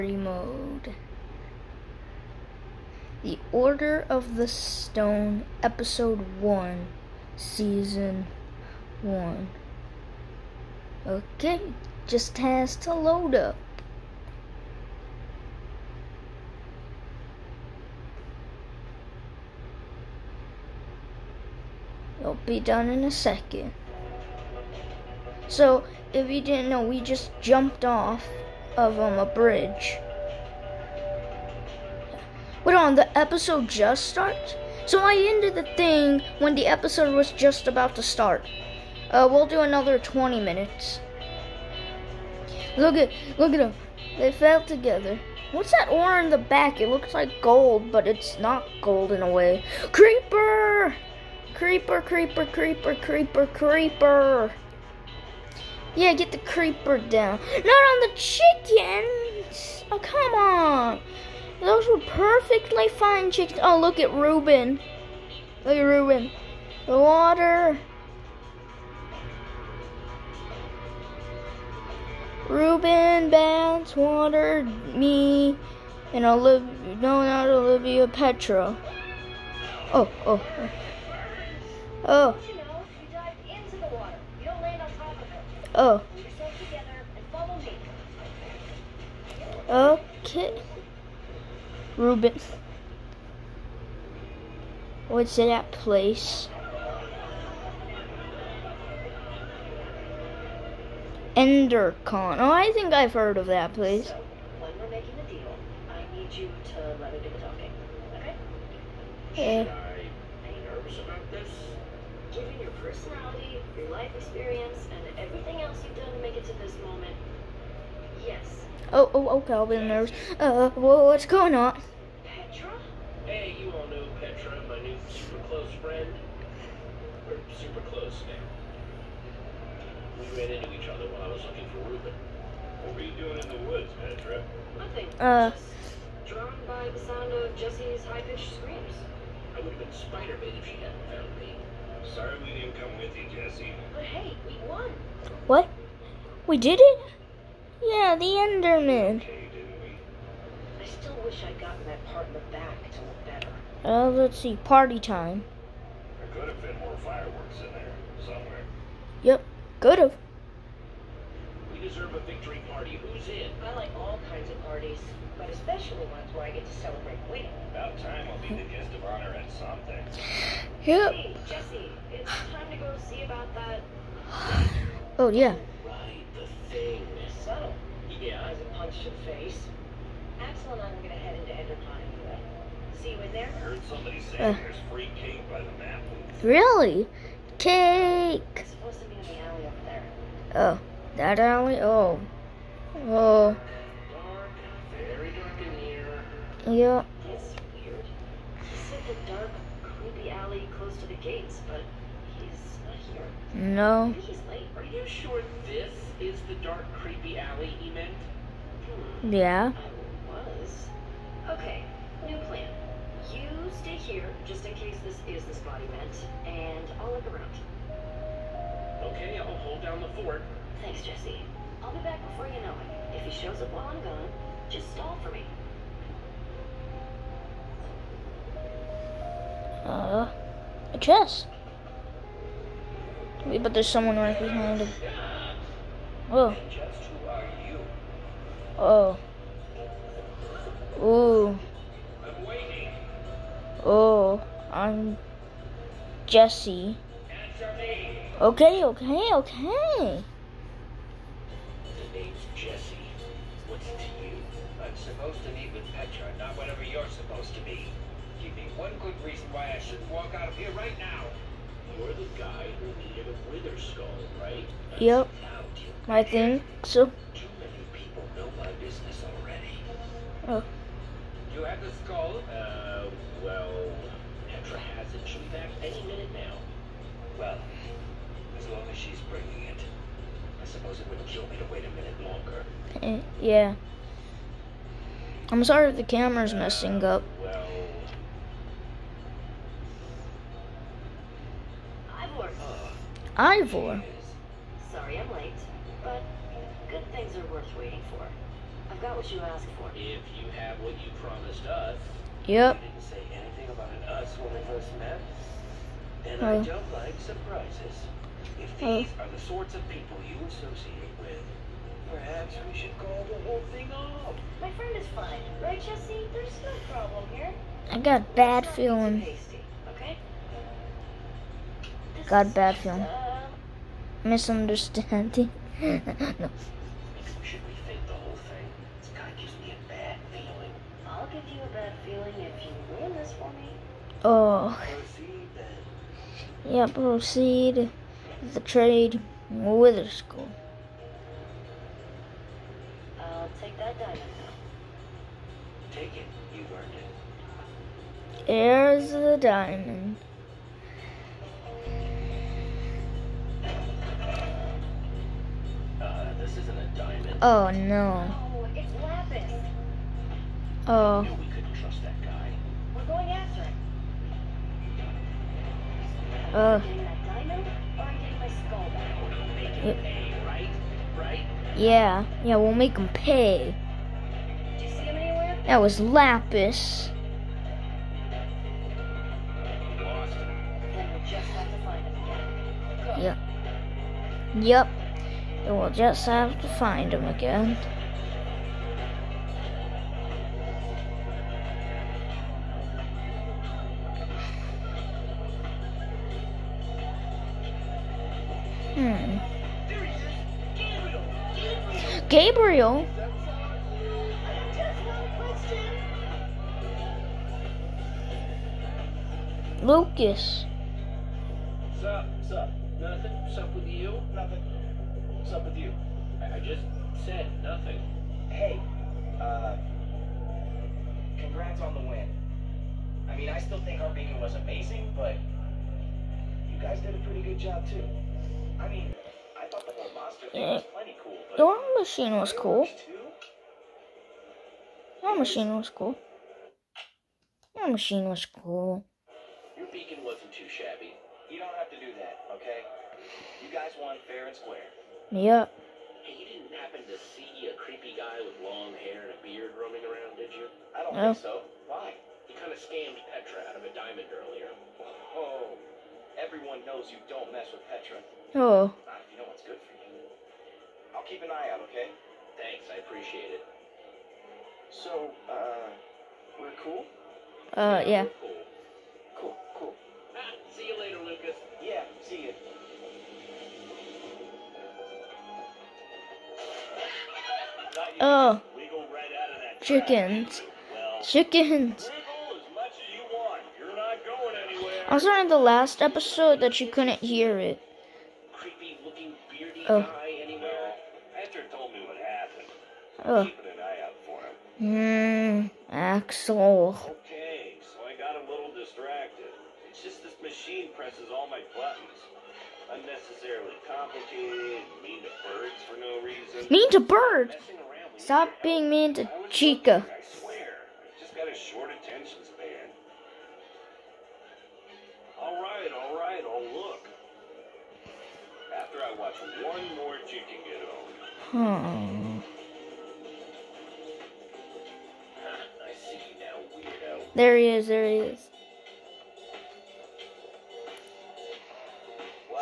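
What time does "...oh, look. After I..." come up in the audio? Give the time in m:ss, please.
8:36.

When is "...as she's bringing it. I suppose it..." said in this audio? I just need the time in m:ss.
4:38.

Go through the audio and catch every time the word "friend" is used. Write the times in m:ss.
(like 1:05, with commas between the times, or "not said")
2:05, 5:14.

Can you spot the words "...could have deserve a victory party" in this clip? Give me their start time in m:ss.
2:39.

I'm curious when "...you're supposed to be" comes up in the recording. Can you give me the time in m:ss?
4:16.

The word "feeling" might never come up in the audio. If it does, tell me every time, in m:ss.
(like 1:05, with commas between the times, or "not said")
5:18, 5:22.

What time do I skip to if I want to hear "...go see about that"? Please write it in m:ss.
2:52.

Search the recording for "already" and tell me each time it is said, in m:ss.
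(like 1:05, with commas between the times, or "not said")
4:29.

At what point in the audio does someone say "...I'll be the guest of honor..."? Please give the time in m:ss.
2:48.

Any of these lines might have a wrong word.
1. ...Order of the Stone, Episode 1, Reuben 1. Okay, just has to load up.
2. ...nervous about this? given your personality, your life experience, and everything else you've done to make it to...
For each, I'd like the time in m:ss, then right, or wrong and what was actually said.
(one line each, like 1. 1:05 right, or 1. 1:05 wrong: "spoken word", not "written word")
1. 0:03 wrong: "Season", not "Reuben"
2. 1:50 right.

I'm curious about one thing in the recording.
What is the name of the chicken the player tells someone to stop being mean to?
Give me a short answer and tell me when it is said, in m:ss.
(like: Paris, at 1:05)
Chica, at 8:29.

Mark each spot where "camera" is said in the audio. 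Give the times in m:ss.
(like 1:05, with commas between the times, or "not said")
4:46.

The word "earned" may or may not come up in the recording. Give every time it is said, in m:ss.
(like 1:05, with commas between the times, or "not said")
5:46.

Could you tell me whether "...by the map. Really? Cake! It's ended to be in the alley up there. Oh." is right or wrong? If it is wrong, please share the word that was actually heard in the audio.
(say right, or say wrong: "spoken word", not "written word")
wrong: "supposed", not "ended".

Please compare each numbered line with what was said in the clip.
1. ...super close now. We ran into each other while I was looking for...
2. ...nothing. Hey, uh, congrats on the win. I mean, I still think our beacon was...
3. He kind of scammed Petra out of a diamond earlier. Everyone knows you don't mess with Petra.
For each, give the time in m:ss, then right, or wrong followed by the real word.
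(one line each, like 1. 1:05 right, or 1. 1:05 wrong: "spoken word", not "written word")
1. 2:07 right
2. 6:57 right
3. 7:32 right.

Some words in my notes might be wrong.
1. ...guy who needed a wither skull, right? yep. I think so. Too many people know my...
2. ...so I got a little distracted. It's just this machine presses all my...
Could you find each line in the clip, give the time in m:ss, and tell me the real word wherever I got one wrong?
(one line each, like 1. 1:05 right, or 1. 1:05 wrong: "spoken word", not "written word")
1. 4:22 right
2. 8:17 right.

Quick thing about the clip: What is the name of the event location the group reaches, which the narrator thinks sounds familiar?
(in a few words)
Endercon.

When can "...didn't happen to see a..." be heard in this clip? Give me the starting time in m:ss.
7:26.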